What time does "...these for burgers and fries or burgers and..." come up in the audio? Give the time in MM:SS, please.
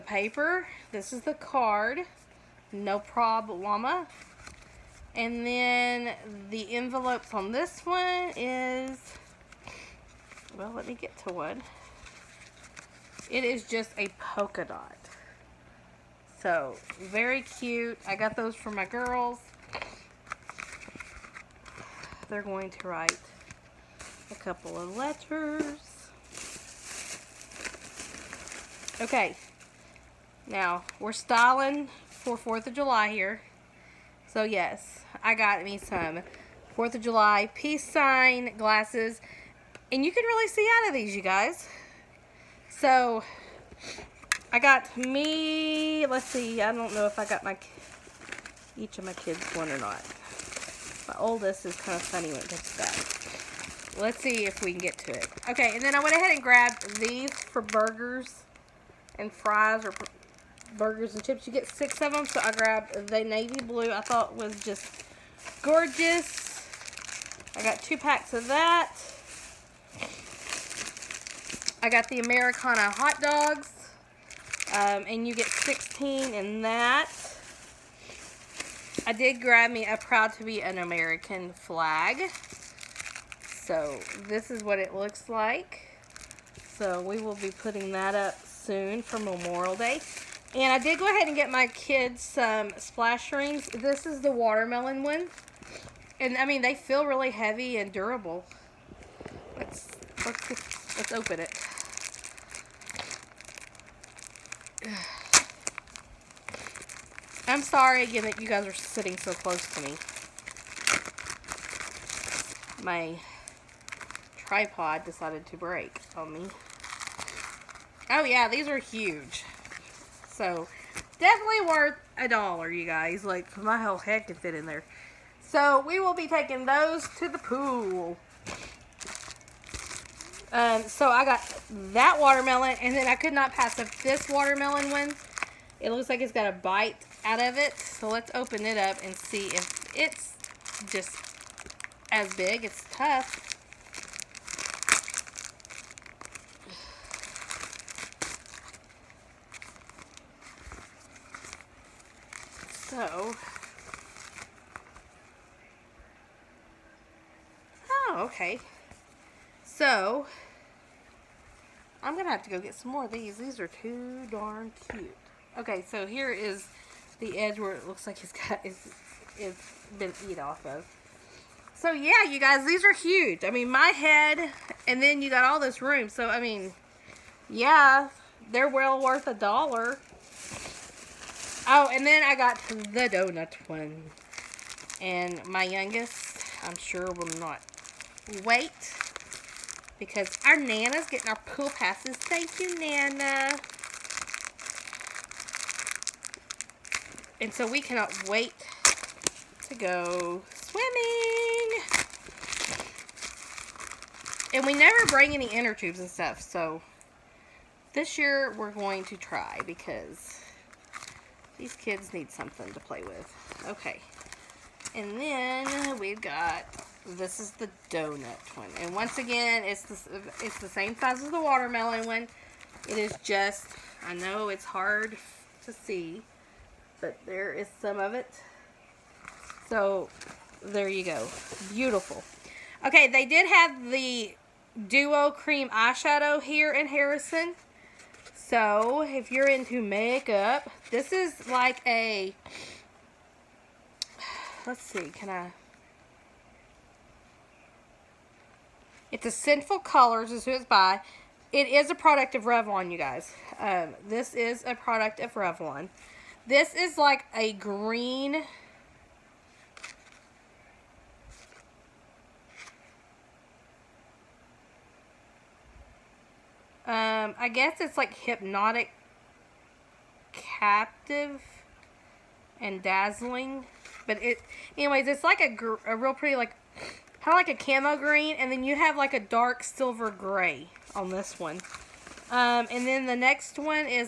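00:56.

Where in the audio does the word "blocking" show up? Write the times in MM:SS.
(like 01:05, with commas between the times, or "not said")
not said.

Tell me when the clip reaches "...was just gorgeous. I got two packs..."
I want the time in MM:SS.
01:04.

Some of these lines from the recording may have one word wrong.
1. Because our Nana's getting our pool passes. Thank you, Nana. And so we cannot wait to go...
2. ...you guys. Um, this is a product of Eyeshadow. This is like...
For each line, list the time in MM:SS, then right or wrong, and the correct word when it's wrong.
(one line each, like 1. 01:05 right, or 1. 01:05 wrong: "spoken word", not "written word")
1. 03:09 right
2. 04:12 wrong: "Revlon", not "Eyeshadow".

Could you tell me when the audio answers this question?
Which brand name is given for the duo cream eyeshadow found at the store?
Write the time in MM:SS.
04:09.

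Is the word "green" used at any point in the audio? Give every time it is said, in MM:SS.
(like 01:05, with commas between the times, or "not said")
04:17, 04:37.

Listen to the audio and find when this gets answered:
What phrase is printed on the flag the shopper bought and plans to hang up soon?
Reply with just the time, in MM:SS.
01:19.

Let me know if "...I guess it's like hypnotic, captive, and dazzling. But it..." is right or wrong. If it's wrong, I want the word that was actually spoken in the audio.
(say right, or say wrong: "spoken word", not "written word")
right.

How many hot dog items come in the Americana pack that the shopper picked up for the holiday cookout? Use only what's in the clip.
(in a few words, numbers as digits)
16.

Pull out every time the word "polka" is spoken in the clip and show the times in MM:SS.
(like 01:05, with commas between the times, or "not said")
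00:14.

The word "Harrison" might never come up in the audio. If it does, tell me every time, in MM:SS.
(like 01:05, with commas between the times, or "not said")
03:56.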